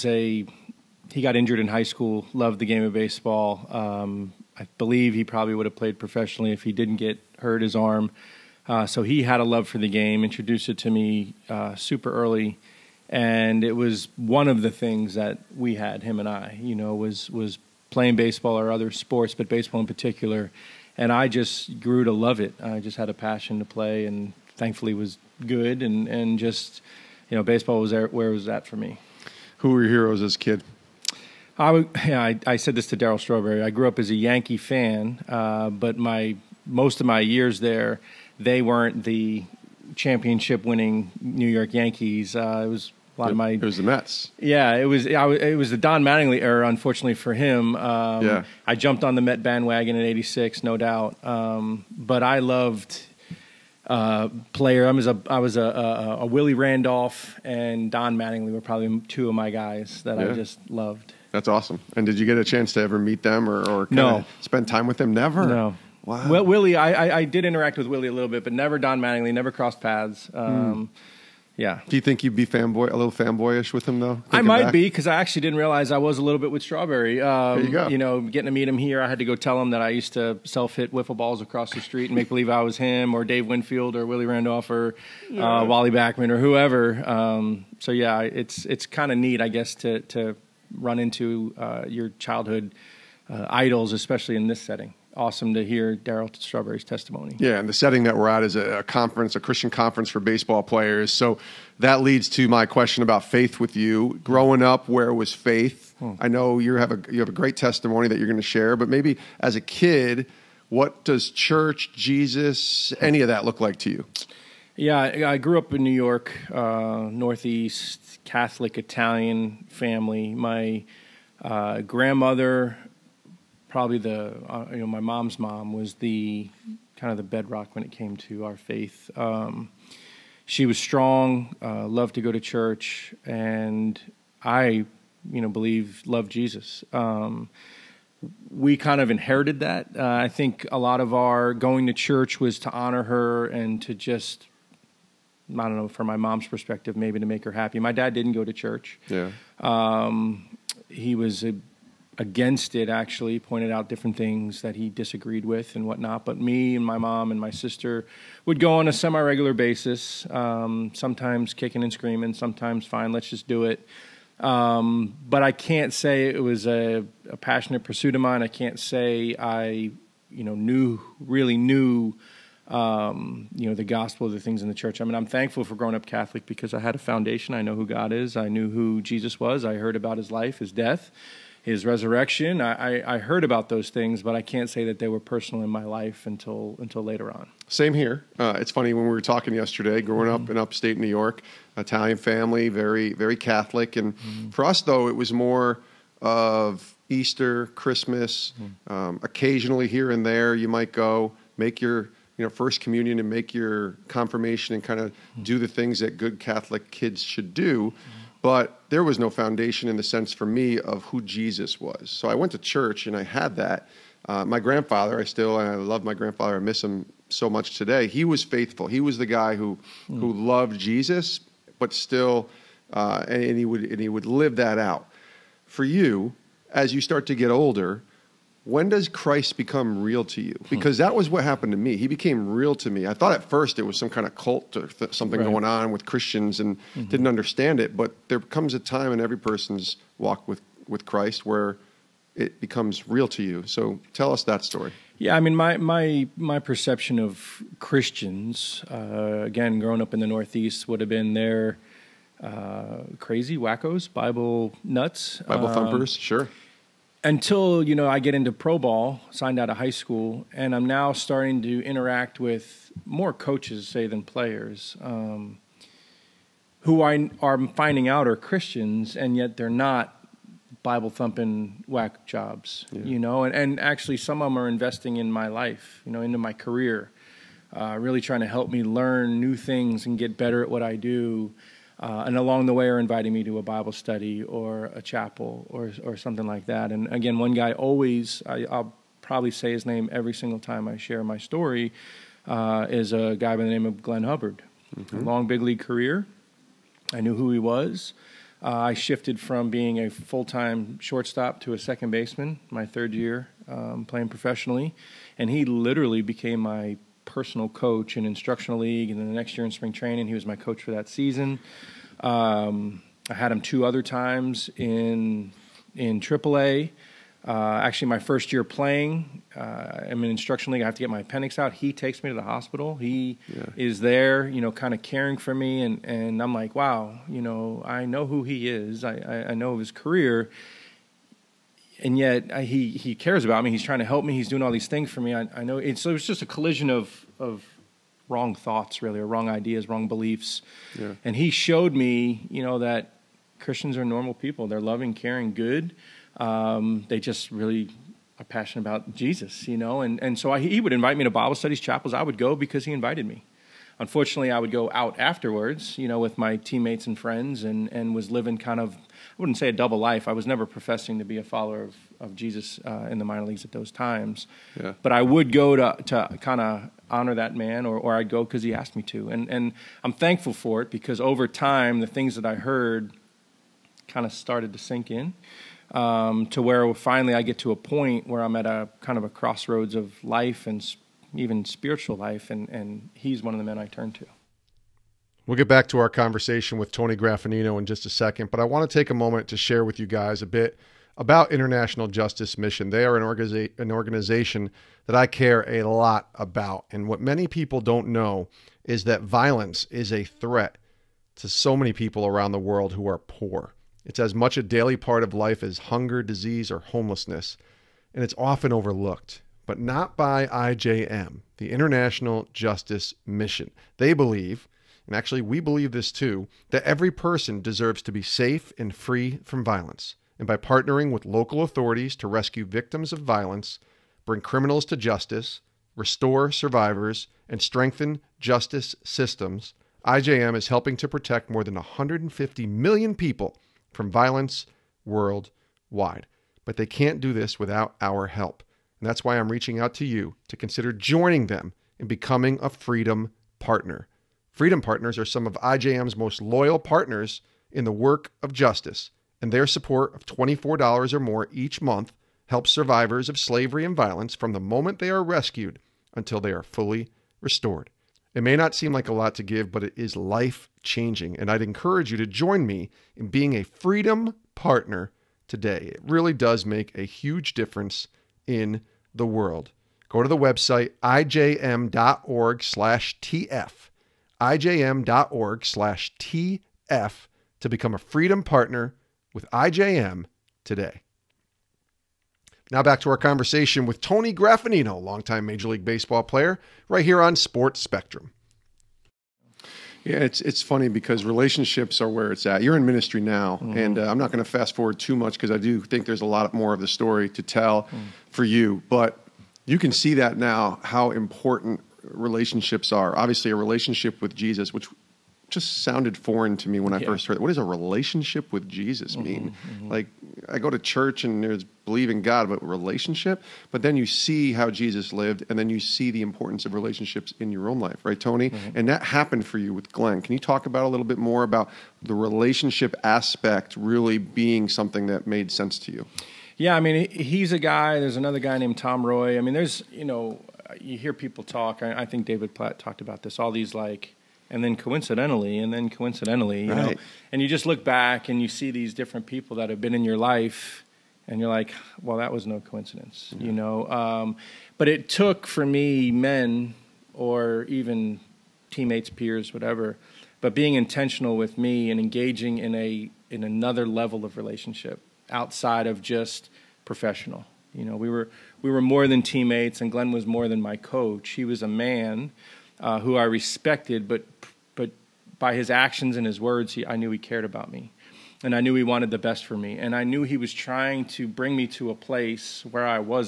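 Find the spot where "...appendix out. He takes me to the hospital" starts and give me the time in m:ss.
5:21.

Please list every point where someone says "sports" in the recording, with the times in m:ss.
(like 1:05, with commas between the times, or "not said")
0:18, 8:07.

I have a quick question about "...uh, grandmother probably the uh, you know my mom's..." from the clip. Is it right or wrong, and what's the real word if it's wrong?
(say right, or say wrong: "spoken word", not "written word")
right.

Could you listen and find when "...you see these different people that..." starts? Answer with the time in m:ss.
8:58.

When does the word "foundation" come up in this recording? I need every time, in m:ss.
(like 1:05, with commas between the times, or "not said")
2:56, 3:29.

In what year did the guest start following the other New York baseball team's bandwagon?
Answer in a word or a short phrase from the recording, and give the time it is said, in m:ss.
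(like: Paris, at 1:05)
1986, at 0:50.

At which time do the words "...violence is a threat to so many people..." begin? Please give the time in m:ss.
6:39.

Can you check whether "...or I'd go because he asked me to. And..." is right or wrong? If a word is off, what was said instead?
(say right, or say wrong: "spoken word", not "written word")
right.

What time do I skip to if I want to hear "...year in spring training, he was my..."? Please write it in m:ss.
5:09.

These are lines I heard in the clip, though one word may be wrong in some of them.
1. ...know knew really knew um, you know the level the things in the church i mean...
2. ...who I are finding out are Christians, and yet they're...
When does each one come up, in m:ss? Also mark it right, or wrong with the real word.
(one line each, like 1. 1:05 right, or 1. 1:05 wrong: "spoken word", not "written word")
1. 2:50 wrong: "gospel", not "level"
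2. 4:26 right.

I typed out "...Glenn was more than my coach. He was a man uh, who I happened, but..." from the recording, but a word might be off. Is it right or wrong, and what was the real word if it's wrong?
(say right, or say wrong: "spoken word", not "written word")
wrong: "respected", not "happened".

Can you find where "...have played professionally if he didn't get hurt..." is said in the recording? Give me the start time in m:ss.
0:05.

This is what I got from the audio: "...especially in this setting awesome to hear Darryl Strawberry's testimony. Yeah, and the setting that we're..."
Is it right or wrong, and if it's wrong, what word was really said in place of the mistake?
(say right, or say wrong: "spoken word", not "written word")
right.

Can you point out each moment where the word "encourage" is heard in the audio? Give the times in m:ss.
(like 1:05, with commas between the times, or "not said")
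7:41.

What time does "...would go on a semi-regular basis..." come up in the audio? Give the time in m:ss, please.
2:38.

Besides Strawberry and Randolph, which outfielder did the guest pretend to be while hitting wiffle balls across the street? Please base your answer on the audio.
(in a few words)
Dave Winfield.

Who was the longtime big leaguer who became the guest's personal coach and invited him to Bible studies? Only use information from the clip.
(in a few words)
Glenn Hubbard.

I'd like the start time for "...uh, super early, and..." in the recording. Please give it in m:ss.
0:11.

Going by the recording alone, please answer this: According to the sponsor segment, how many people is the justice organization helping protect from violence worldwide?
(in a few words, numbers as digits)
150 million.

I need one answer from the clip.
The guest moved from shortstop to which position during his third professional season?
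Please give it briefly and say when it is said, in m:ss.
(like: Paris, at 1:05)
Second baseman, at 5:01.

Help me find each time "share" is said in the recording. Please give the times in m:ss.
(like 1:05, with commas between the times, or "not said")
1:48, 4:50, 6:29.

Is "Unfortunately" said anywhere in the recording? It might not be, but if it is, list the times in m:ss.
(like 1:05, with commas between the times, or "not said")
0:46, 5:53.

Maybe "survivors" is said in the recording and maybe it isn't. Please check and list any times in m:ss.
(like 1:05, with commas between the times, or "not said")
7:06, 7:32.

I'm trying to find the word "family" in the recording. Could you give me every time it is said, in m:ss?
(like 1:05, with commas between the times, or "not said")
1:59, 3:12.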